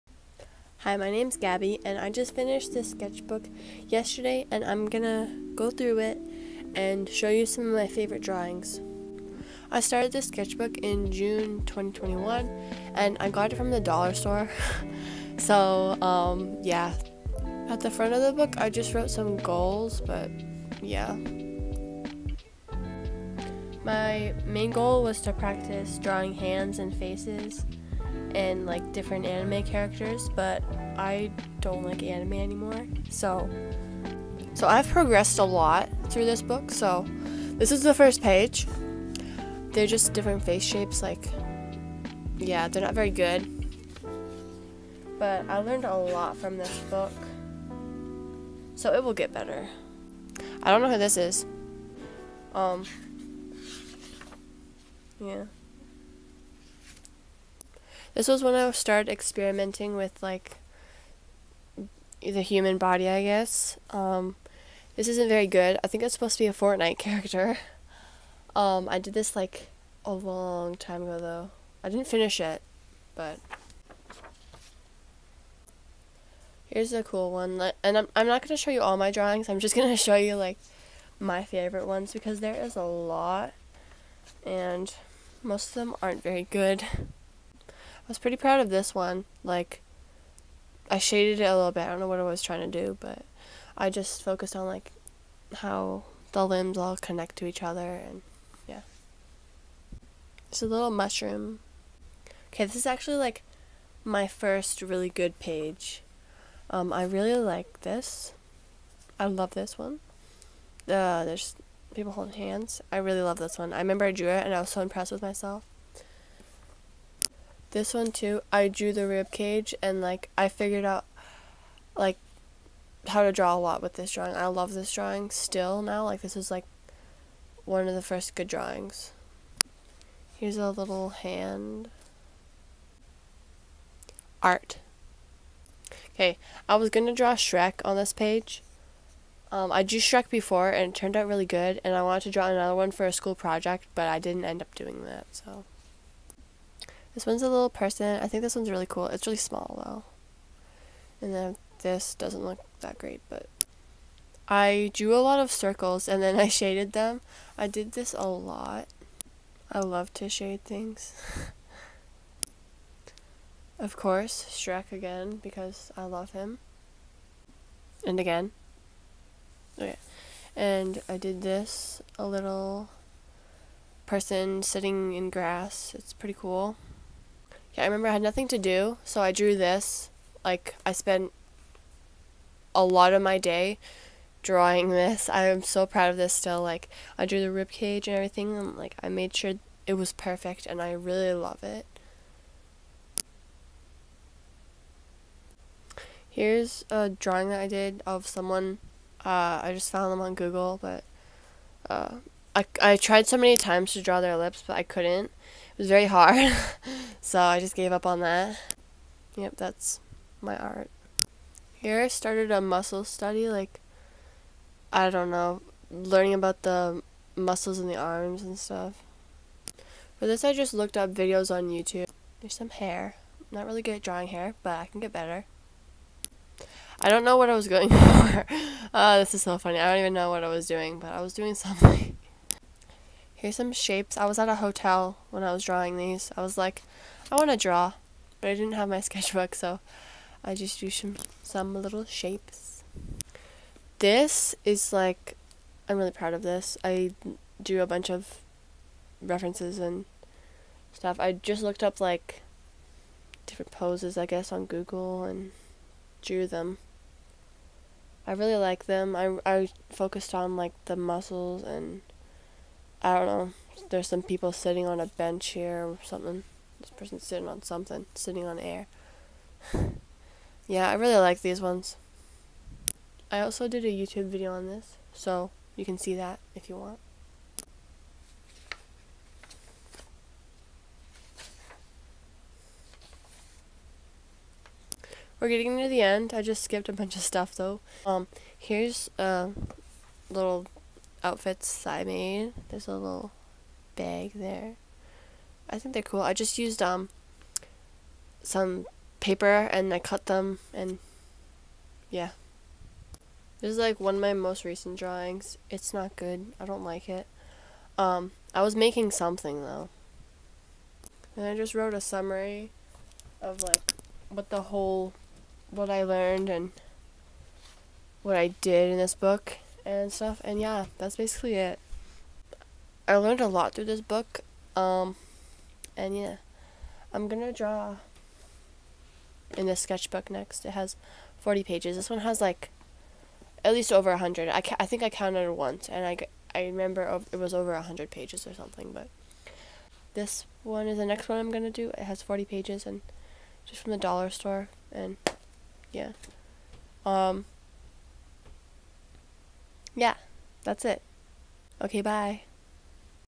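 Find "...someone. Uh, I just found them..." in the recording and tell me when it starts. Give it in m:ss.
3:18.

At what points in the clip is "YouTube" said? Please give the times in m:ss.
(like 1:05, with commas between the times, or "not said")
3:41, 4:33.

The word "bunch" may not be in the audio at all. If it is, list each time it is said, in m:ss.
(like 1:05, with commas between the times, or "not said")
4:07, 4:46.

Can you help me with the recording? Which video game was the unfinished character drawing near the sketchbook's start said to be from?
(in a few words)
Fortnite.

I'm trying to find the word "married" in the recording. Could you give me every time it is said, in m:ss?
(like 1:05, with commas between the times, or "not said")
not said.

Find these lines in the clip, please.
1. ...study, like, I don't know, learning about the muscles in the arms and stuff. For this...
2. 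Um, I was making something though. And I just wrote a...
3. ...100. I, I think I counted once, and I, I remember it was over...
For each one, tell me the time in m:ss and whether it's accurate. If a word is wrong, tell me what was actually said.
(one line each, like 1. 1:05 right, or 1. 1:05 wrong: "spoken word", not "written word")
1. 3:33 right
2. 5:07 right
3. 5:34 right.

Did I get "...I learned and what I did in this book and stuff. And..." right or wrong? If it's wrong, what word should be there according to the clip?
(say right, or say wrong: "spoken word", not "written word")
right.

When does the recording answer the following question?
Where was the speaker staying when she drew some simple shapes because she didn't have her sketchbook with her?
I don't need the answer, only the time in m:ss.
3:54.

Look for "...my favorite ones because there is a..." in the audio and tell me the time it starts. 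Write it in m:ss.
1:21.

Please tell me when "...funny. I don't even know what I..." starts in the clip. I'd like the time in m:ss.
3:49.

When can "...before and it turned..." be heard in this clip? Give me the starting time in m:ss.
2:20.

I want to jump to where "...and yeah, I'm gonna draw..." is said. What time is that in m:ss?
5:25.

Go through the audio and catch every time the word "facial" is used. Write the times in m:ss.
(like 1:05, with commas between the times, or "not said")
not said.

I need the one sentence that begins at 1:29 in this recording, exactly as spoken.
Like, I shaded it a little bit.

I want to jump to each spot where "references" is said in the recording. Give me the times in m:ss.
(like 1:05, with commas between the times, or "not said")
4:09.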